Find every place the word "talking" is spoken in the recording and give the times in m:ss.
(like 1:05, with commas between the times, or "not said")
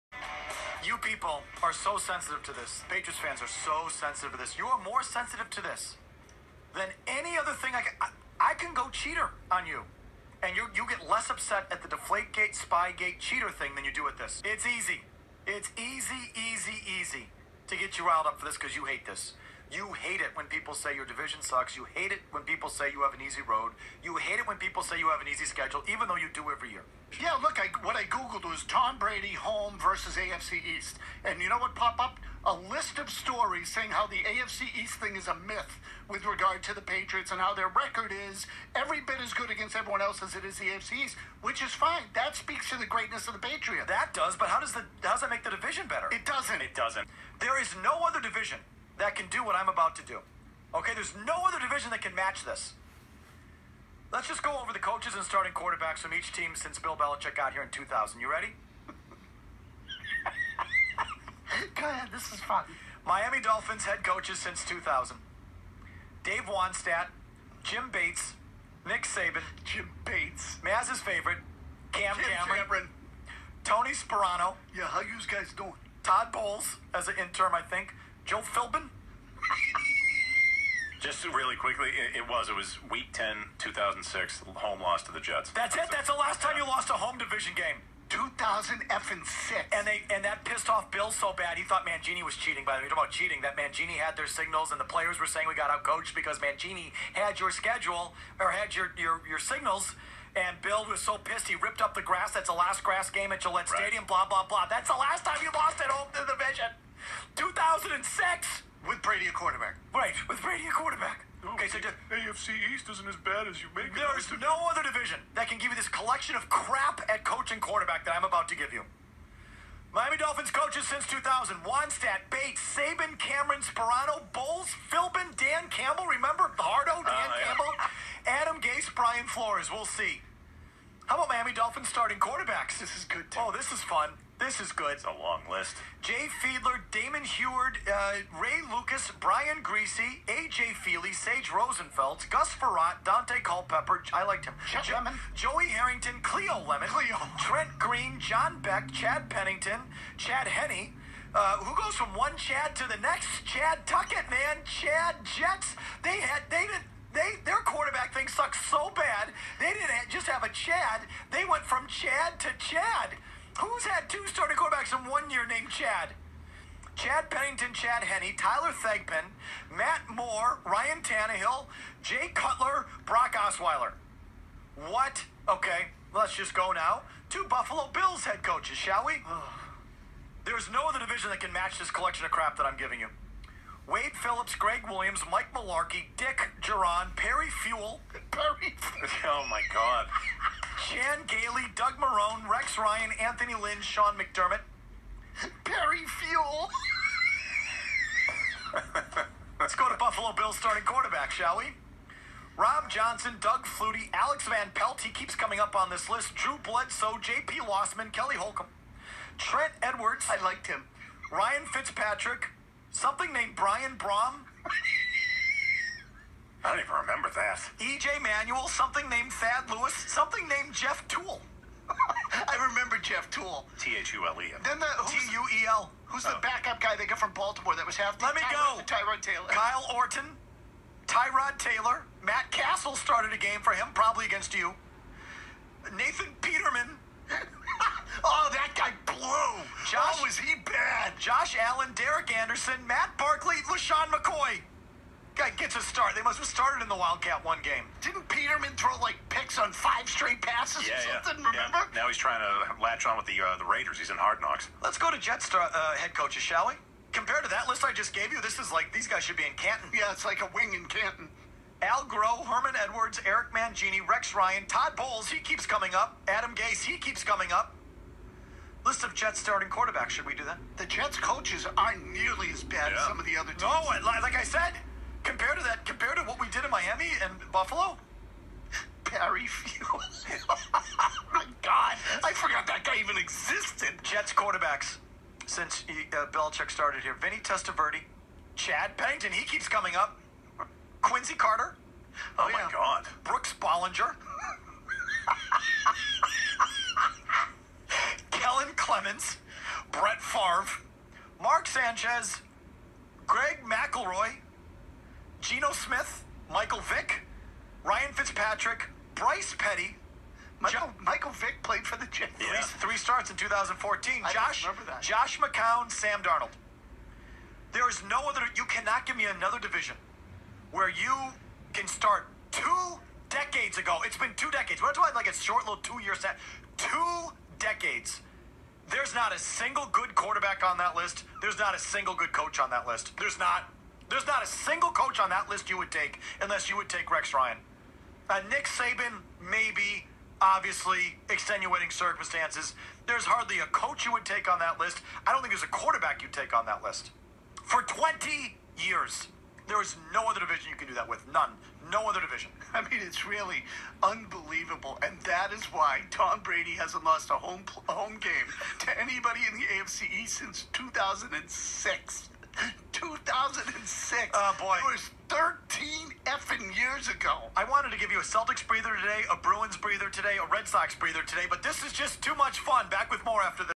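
1:32, 5:24.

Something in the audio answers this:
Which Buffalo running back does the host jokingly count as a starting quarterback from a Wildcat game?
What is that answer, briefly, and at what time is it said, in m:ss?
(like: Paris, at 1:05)
LeSean McCoy, at 4:03.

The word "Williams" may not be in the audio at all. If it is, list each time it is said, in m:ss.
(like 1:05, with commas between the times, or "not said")
3:04.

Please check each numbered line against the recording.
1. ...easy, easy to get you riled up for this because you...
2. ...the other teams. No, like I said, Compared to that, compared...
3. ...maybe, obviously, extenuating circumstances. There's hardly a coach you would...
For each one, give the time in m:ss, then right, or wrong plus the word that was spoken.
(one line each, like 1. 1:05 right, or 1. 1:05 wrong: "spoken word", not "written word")
1. 0:16 right
2. 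4:33 right
3. 5:39 right.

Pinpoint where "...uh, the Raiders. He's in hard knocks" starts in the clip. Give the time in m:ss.
4:13.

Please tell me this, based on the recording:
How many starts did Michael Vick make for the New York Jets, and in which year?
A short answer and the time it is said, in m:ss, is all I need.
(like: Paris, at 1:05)
3 starts, 2014, at 5:12.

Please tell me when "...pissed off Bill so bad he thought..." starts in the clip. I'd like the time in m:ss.
1:30.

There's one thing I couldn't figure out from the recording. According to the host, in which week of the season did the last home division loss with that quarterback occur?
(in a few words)
Week 10.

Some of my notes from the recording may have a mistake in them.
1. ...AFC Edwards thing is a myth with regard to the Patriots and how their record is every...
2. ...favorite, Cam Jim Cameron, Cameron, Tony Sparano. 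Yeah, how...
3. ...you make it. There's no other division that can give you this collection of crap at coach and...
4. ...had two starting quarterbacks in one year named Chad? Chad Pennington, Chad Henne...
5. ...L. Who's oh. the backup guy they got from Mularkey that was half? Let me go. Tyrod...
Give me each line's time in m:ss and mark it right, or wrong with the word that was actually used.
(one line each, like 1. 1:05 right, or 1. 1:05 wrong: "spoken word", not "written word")
1. 0:34 wrong: "East", not "Edwards"
2. 1:10 right
3. 1:53 right
4. 2:43 right
5. 3:45 wrong: "Baltimore", not "Mularkey".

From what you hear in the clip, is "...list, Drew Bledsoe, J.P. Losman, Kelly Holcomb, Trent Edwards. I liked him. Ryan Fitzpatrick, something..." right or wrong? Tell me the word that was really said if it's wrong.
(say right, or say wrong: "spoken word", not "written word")
right.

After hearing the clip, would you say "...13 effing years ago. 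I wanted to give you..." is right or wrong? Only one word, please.
right.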